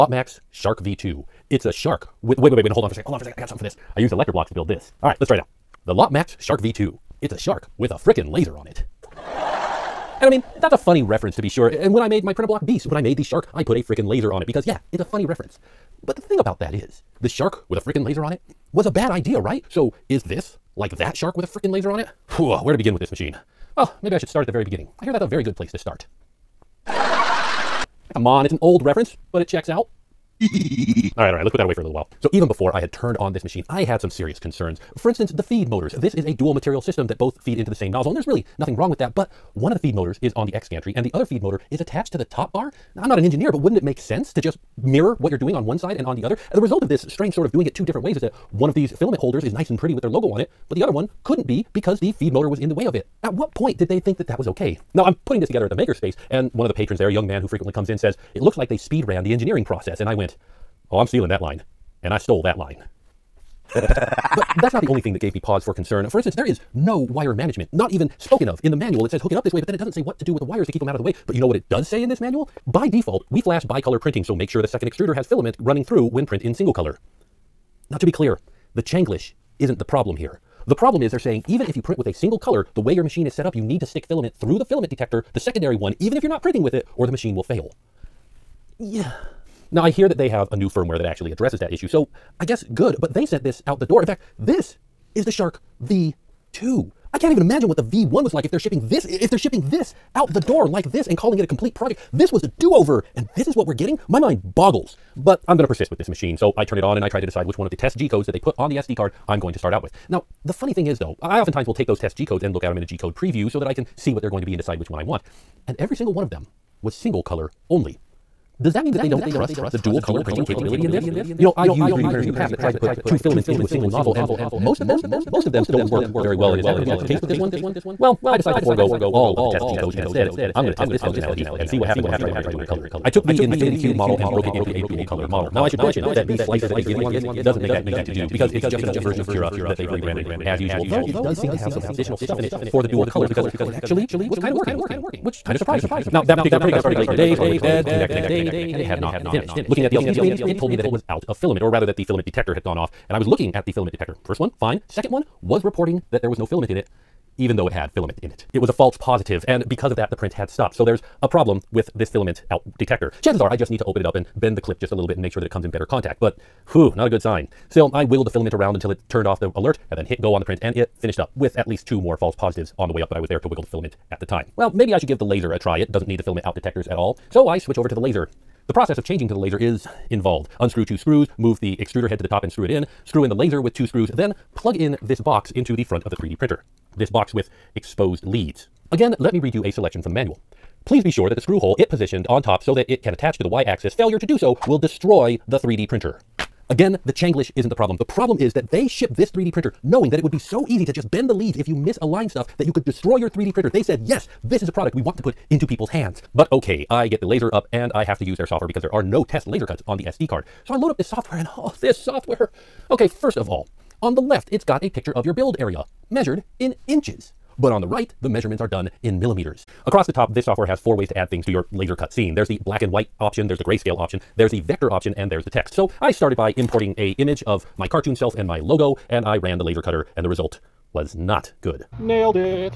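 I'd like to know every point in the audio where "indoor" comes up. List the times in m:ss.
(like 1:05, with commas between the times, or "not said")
not said.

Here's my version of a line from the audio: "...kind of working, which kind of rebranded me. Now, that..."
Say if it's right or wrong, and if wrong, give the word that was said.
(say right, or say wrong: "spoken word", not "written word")
wrong: "surprised", not "rebranded".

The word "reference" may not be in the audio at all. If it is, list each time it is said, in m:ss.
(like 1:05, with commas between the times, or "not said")
0:11, 0:15, 0:28.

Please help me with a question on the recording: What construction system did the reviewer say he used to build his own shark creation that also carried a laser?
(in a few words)
Electro blocks.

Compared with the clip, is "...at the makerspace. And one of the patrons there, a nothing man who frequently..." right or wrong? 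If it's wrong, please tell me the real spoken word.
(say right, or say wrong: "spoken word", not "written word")
wrong: "young", not "nothing".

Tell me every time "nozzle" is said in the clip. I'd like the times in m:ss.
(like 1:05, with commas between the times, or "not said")
0:37, 2:03.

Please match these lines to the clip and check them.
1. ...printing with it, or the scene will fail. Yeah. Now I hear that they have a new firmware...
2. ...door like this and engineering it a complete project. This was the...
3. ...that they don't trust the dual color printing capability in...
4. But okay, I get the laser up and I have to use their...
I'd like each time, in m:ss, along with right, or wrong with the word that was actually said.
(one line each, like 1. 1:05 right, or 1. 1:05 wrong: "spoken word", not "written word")
1. 1:26 wrong: "machine", not "scene"
2. 1:40 wrong: "calling", not "engineering"
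3. 1:58 right
4. 3:26 right.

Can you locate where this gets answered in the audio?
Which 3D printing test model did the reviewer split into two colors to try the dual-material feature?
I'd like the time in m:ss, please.
2:13.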